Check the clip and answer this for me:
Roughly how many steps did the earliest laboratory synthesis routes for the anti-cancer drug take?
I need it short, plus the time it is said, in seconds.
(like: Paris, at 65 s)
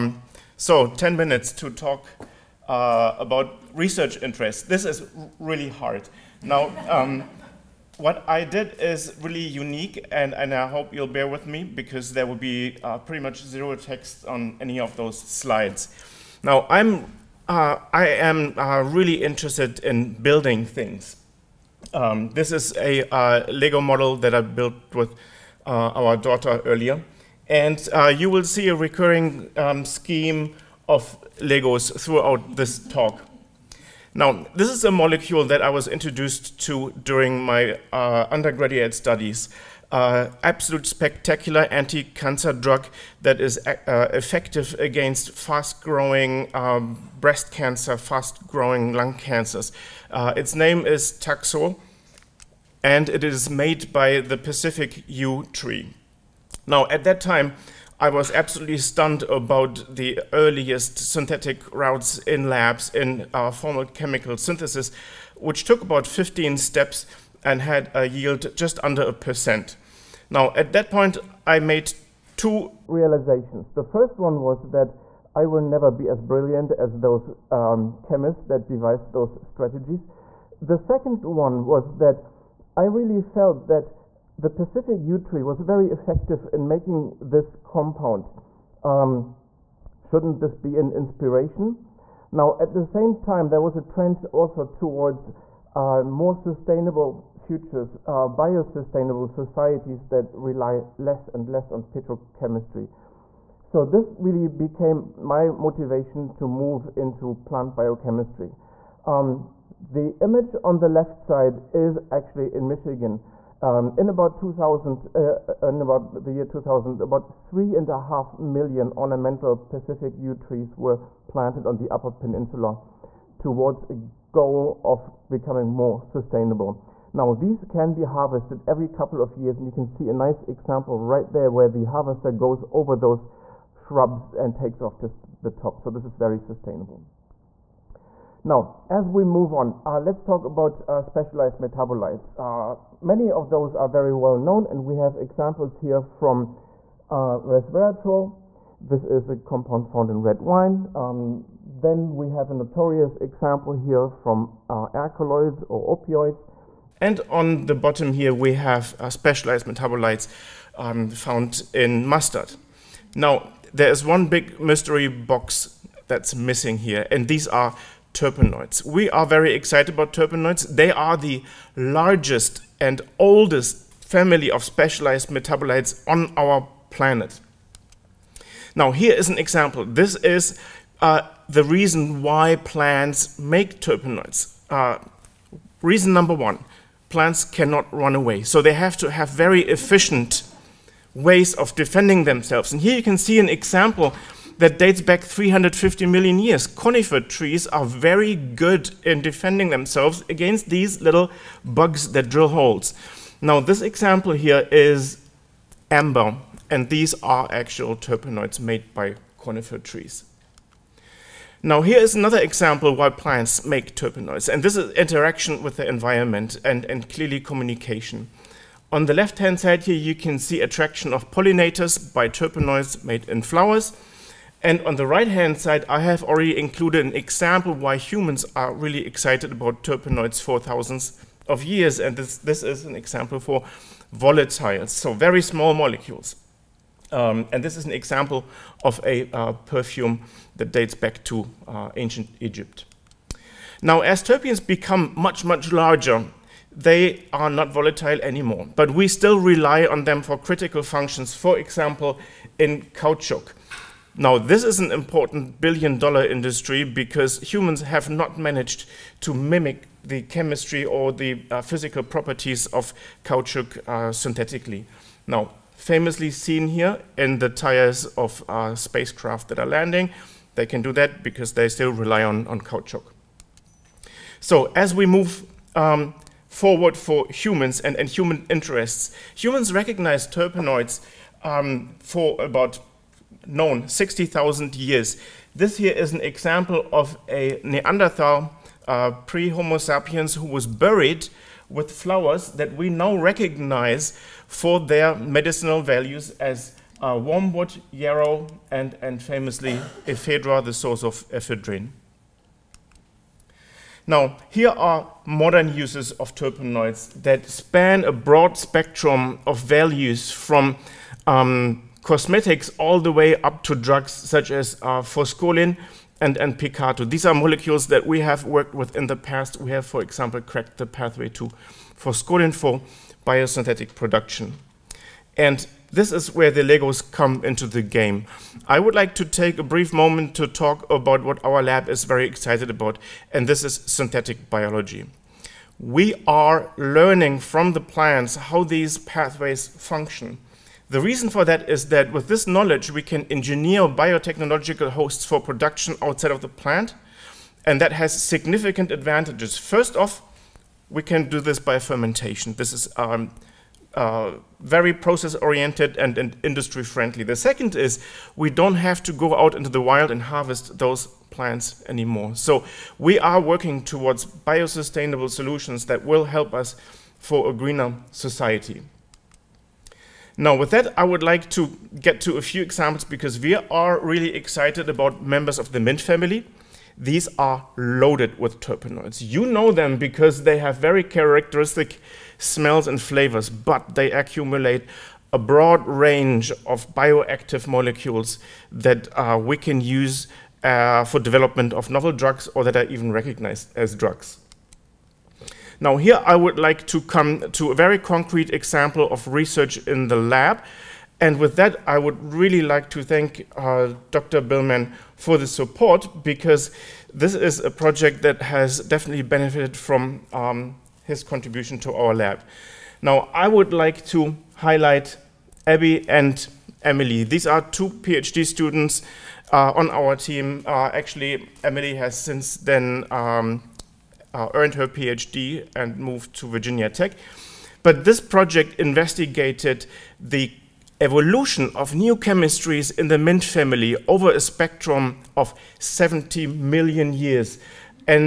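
15, at 66 s.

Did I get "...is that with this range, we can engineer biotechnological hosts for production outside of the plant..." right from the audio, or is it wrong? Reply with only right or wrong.
wrong.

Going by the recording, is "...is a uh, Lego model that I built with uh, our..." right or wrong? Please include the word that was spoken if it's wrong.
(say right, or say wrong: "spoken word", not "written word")
right.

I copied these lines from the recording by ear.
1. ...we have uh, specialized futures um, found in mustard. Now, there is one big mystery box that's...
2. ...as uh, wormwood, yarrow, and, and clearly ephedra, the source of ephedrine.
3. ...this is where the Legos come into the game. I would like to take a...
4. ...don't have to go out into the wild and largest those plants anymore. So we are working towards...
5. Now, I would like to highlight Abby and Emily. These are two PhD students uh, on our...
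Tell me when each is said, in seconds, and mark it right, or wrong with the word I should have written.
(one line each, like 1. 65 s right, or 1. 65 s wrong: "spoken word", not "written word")
1. 158 s wrong: "metabolites", not "futures"
2. 296 s wrong: "famously", not "clearly"
3. 325 s right
4. 358 s wrong: "harvest", not "largest"
5. 413 s right.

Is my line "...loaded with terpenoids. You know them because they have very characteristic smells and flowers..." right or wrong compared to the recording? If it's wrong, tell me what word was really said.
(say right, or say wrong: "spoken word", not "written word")
wrong: "flavors", not "flowers".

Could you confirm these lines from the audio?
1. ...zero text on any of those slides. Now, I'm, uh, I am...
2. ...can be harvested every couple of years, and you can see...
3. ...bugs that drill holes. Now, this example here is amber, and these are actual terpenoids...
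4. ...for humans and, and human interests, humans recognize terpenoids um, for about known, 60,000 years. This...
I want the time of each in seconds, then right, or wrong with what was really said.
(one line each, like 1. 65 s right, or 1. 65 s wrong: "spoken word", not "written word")
1. 13 s right
2. 127 s right
3. 201 s right
4. 276 s right.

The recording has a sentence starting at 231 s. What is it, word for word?
And this, this is an example for volatiles, so very small molecules.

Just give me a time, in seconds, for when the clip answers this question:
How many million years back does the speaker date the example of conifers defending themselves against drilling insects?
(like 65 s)
195 s.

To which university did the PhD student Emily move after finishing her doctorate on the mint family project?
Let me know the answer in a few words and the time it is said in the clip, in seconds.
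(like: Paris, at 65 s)
Virginia Tech, at 426 s.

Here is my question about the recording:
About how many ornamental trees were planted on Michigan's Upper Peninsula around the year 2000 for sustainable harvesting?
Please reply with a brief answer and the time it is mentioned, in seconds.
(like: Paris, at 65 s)
3.5 million, at 117 s.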